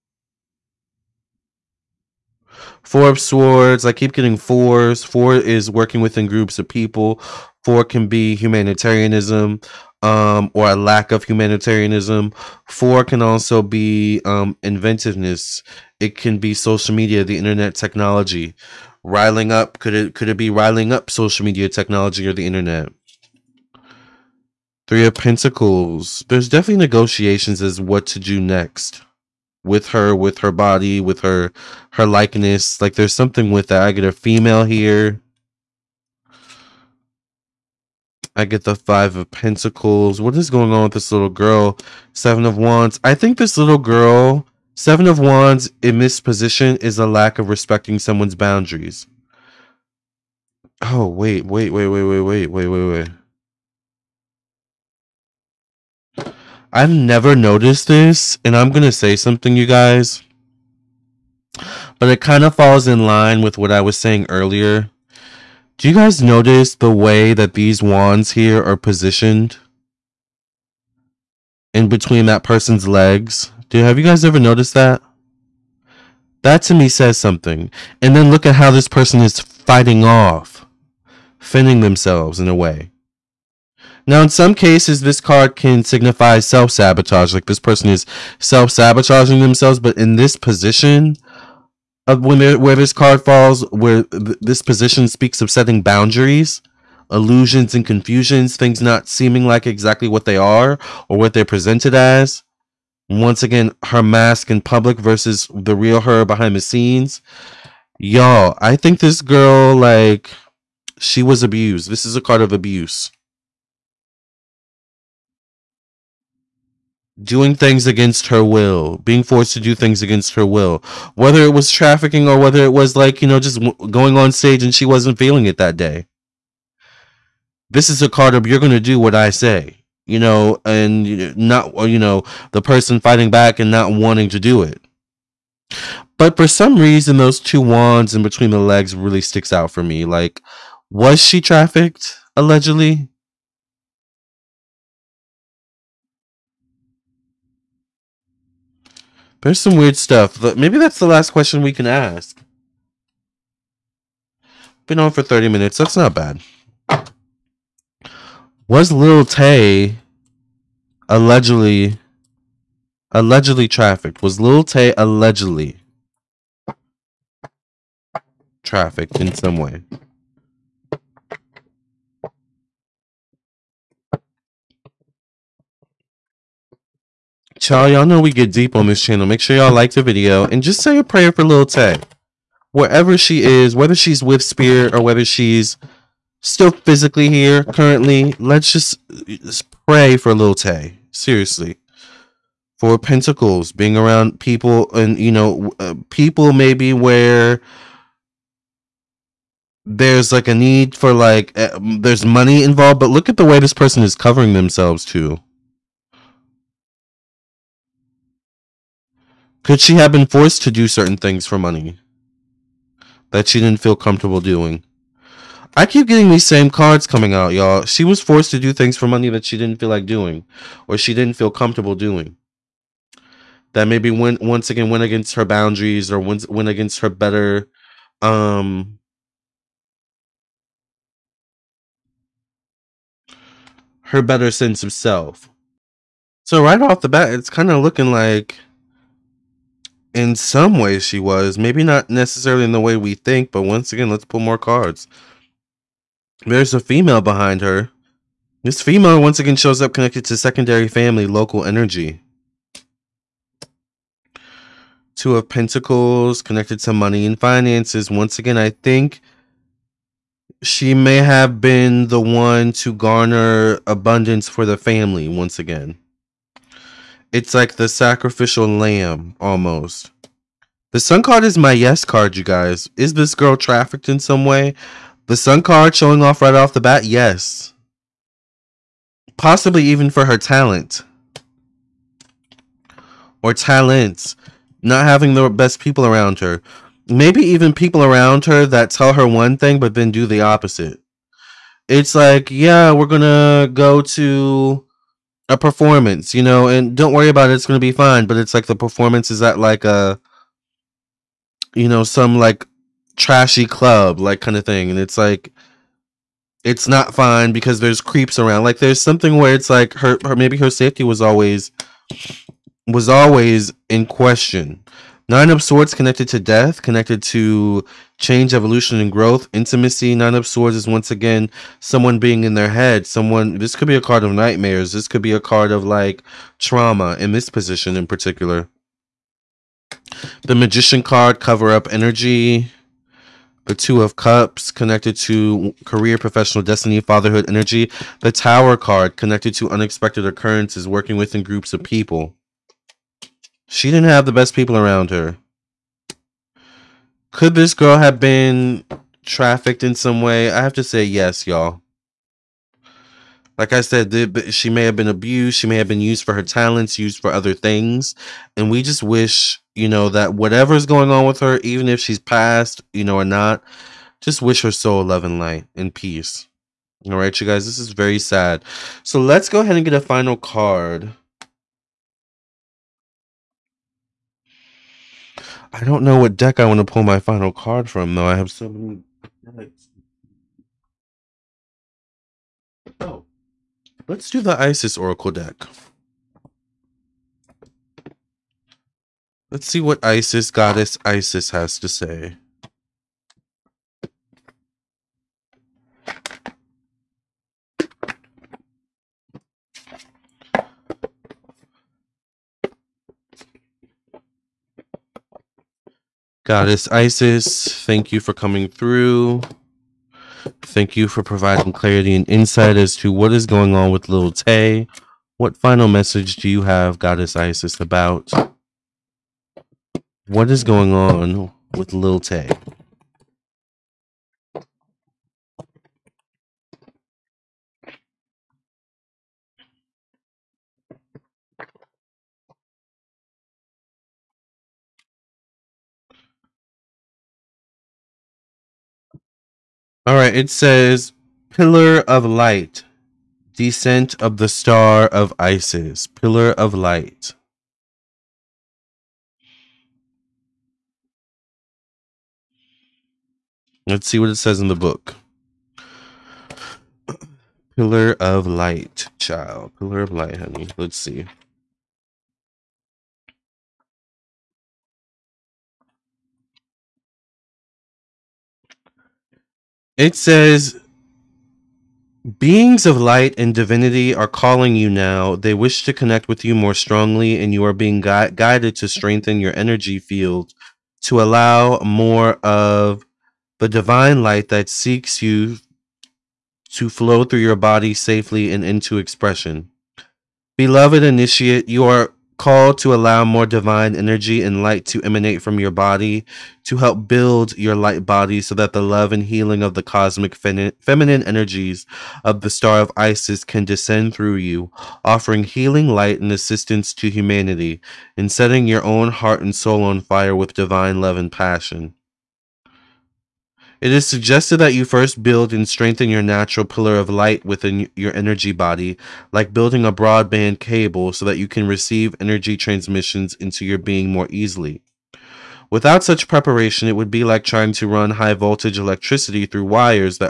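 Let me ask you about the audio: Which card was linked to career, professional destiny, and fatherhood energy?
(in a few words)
Two of Cups.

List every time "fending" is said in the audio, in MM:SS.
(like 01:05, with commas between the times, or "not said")
01:21.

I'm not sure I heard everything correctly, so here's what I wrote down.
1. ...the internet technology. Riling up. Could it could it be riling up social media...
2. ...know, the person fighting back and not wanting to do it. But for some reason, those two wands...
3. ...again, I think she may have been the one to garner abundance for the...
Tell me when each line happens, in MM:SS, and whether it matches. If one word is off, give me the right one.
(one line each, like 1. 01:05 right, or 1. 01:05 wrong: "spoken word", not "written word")
1. 00:17 right
2. 02:11 right
3. 04:18 right.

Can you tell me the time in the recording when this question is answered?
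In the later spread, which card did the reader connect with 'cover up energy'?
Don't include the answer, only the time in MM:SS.
05:30.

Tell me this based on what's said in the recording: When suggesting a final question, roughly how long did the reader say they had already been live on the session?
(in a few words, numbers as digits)
30 minutes.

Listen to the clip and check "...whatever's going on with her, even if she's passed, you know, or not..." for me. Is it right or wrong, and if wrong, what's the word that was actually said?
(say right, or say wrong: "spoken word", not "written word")
right.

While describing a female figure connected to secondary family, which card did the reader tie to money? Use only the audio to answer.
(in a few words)
Two of Pentacles.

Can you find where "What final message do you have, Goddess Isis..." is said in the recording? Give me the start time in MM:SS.
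06:55.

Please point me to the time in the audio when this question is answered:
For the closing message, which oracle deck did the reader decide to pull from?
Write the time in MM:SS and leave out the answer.
06:24.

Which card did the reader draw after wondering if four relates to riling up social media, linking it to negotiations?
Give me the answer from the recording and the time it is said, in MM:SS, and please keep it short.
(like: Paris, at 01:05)
Three of Pentacles, at 00:24.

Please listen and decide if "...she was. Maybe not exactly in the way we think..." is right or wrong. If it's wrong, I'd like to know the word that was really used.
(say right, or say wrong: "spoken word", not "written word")
wrong: "necessarily", not "exactly".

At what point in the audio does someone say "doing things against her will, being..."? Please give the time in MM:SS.
01:57.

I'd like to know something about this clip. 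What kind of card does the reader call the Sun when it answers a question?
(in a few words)
Yes card.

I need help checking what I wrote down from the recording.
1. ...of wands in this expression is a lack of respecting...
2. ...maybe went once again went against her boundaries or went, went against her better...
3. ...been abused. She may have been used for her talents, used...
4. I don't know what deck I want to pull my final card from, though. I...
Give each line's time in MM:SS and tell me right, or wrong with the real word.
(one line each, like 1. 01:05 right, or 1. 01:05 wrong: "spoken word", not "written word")
1. 00:45 wrong: "position", not "expression"
2. 03:43 right
3. 05:54 right
4. 06:15 right.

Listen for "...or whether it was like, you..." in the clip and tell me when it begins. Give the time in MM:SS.
02:02.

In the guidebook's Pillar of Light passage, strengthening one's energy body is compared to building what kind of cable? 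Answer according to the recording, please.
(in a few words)
Broadband cable.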